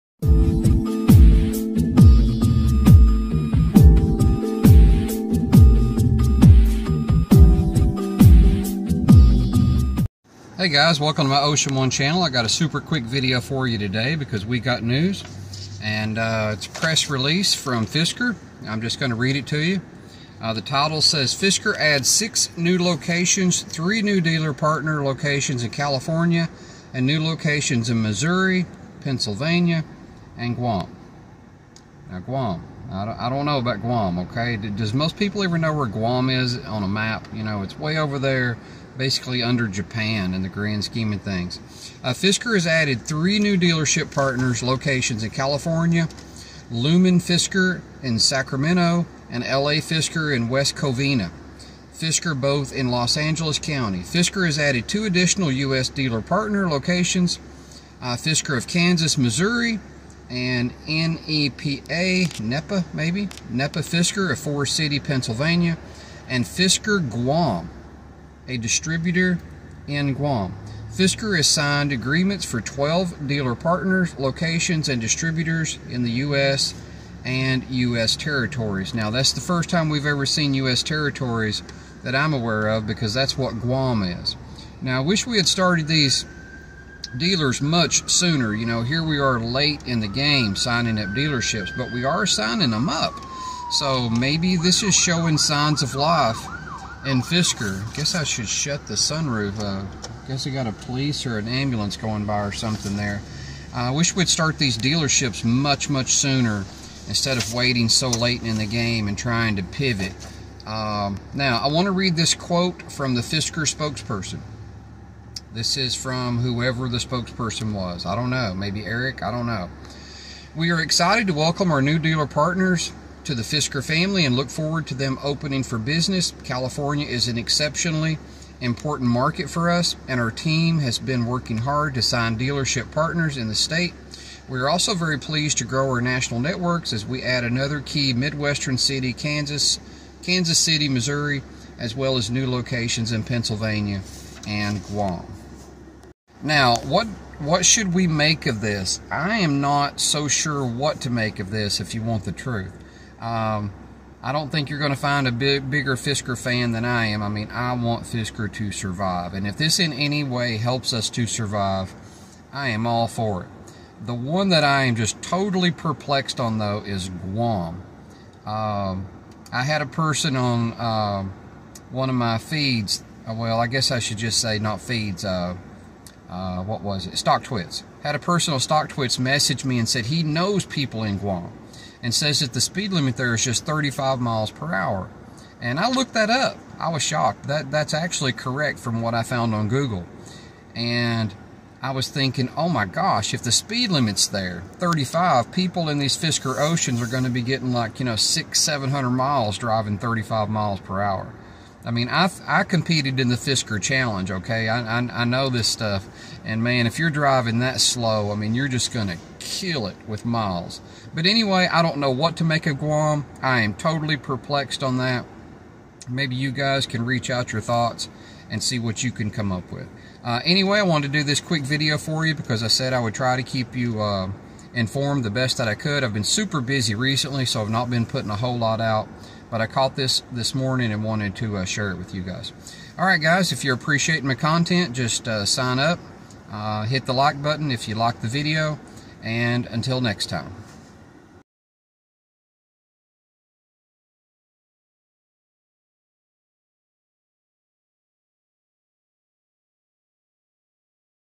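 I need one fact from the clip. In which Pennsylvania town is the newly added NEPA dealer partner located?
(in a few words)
Forest City.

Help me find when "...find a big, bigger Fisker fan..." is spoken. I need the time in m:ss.
2:34.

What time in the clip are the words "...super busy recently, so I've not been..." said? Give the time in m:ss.
3:46.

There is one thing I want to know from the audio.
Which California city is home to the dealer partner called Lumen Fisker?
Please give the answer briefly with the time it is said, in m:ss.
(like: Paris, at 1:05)
Sacramento, at 0:48.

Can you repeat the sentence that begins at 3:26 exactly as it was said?
And man, if you're driving that slow, I mean, you're just going to kill it with miles.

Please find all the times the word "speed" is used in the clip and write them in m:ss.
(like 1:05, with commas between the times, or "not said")
3:02, 3:13.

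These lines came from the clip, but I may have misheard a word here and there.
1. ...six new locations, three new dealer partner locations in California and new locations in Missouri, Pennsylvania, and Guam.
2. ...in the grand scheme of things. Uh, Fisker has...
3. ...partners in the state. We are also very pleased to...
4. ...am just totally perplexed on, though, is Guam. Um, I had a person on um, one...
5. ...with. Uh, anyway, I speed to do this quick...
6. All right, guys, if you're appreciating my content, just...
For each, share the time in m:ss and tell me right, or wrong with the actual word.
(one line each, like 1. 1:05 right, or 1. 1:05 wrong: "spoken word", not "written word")
1. 0:22 right
2. 0:40 right
3. 2:12 right
4. 2:44 right
5. 3:39 wrong: "wanted", not "speed"
6. 3:52 right.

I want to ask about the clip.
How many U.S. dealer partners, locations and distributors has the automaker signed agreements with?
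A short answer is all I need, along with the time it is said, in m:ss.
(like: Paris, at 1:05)
12, at 1:12.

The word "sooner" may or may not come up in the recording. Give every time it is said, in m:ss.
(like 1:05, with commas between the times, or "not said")
1:28, 1:46.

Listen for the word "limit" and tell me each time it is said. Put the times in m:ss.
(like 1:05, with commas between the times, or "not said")
3:02, 3:13.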